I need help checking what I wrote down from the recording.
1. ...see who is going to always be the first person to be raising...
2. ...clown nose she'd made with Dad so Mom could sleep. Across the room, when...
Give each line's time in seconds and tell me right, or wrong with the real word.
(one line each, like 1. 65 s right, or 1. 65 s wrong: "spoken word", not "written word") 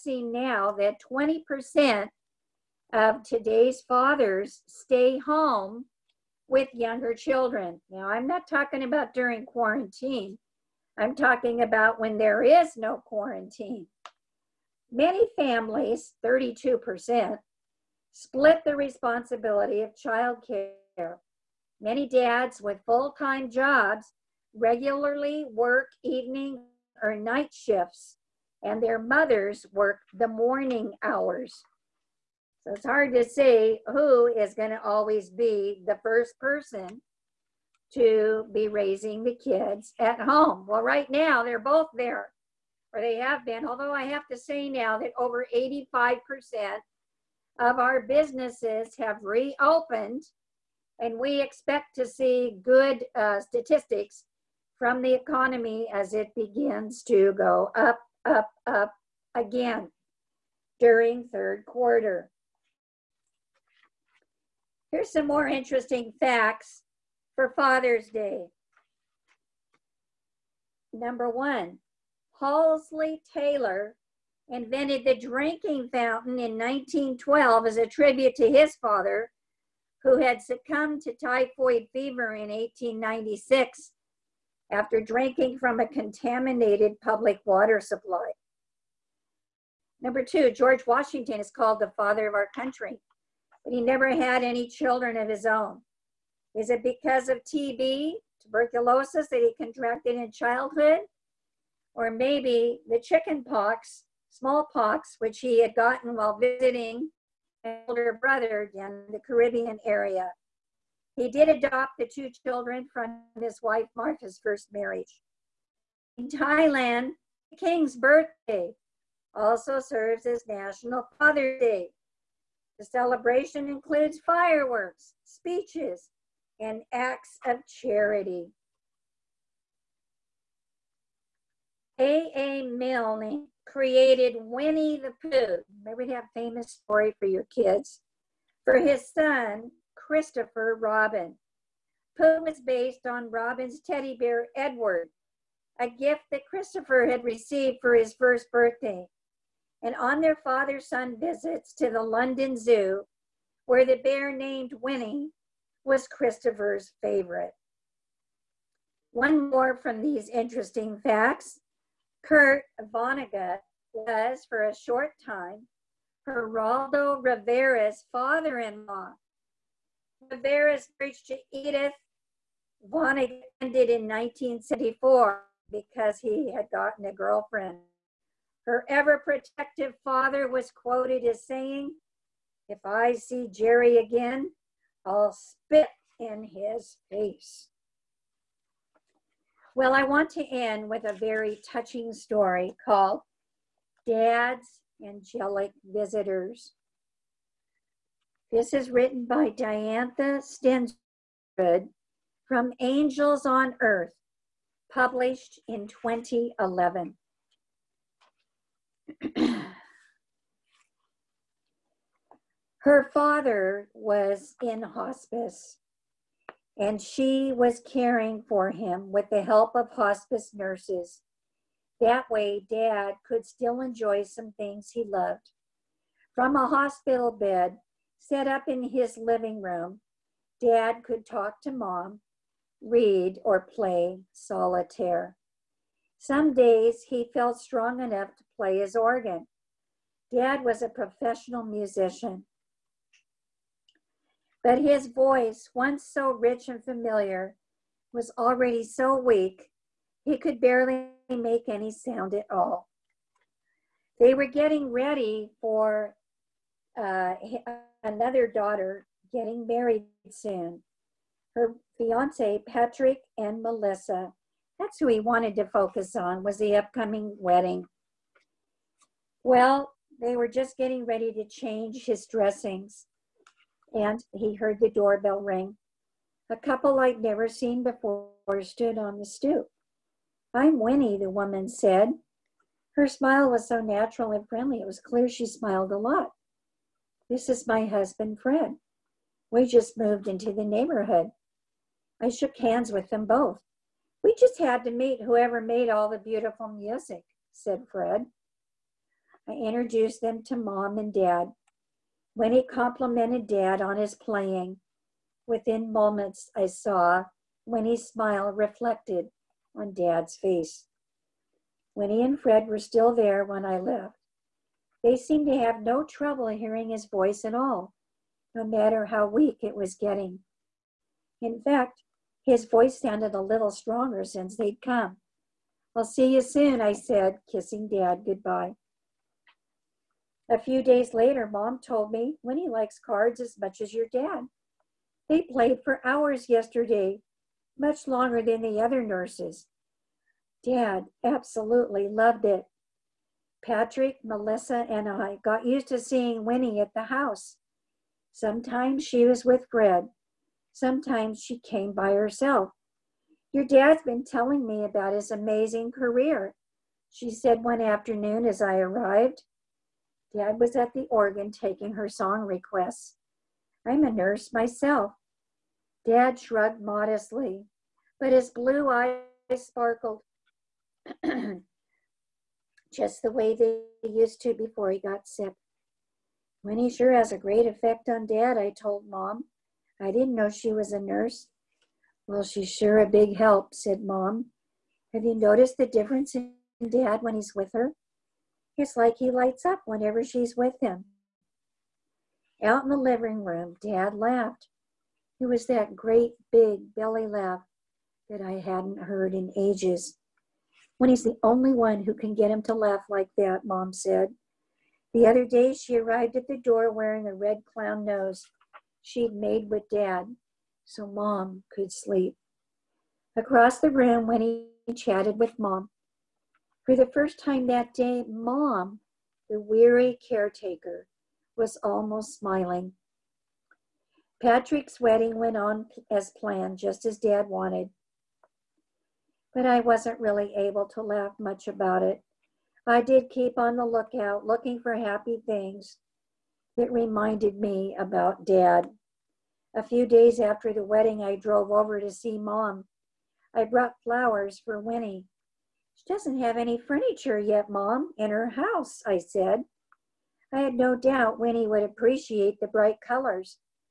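1. 33 s right
2. 407 s right.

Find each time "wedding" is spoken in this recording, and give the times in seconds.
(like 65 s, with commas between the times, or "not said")
267 s, 424 s, 440 s.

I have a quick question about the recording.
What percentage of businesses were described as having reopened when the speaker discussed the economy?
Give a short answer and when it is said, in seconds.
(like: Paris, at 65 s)
85%, at 45 s.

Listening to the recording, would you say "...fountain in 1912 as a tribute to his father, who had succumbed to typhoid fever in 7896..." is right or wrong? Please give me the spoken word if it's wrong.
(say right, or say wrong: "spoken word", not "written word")
wrong: "1896", not "7896".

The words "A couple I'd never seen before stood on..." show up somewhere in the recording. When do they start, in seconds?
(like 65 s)
276 s.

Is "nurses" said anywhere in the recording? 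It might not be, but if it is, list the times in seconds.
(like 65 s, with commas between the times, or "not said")
220 s, 339 s, 364 s, 380 s.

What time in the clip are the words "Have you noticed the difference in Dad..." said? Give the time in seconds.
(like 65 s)
385 s.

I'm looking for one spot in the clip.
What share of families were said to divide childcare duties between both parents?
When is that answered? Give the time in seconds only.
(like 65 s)
16 s.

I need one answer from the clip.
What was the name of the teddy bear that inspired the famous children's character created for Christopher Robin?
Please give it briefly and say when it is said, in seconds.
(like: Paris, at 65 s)
Edward, at 144 s.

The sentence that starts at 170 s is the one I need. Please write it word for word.
Rivera's marriage to Edith Vonnegut ended in 1974 because he had gotten a girlfriend.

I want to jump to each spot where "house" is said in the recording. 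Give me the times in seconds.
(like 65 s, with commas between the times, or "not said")
347 s, 448 s.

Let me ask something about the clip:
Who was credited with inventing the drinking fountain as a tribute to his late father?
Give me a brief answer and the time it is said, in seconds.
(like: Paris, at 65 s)
Halsey Taylor, at 72 s.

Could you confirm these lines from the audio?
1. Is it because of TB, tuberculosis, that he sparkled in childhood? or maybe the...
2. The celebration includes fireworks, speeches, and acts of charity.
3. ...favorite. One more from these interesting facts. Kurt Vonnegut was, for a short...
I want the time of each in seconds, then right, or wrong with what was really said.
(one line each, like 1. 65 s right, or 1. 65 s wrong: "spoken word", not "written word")
1. 96 s wrong: "contracted", not "sparkled"
2. 122 s right
3. 157 s right.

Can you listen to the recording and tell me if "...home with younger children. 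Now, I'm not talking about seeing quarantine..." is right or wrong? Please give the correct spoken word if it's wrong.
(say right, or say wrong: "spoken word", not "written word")
wrong: "during", not "seeing".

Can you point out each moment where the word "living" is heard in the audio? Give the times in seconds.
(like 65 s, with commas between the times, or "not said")
229 s, 392 s.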